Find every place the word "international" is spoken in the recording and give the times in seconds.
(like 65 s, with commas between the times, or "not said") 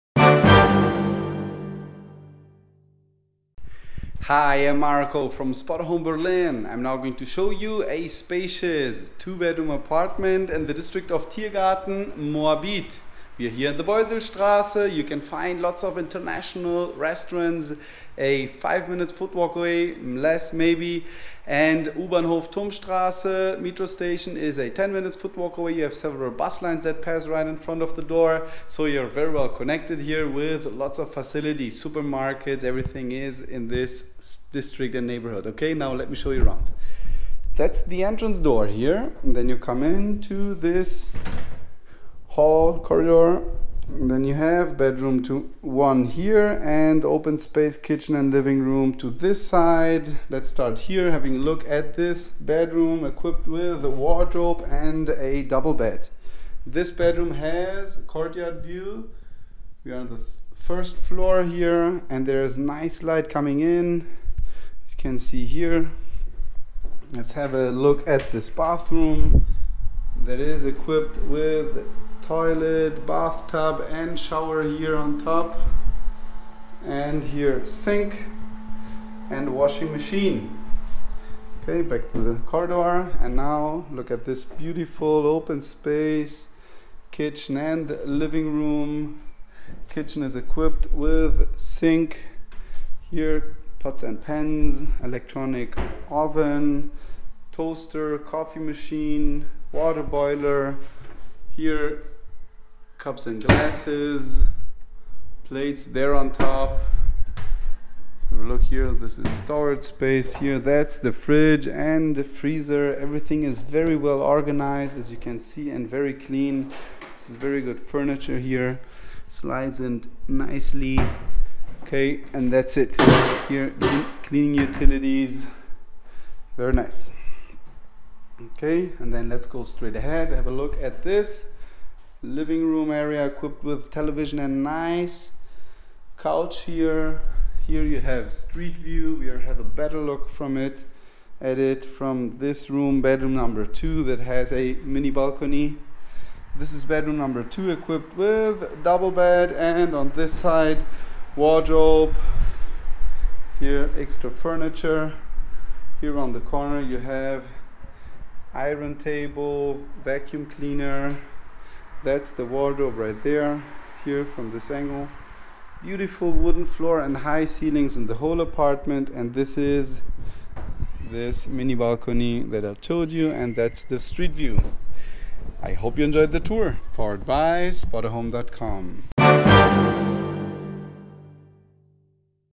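15 s.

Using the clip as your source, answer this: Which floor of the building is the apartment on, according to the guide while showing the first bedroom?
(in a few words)
First floor.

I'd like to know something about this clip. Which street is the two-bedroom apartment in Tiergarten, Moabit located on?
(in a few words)
Beuselstraße.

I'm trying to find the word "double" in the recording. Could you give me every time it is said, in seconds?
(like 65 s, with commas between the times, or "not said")
55 s, 148 s.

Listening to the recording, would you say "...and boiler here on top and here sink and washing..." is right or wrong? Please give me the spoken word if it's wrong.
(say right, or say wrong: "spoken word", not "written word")
wrong: "shower", not "boiler".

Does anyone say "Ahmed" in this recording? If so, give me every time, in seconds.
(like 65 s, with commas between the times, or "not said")
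not said.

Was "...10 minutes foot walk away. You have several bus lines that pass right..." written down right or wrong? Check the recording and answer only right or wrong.
right.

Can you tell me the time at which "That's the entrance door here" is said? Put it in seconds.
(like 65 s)
37 s.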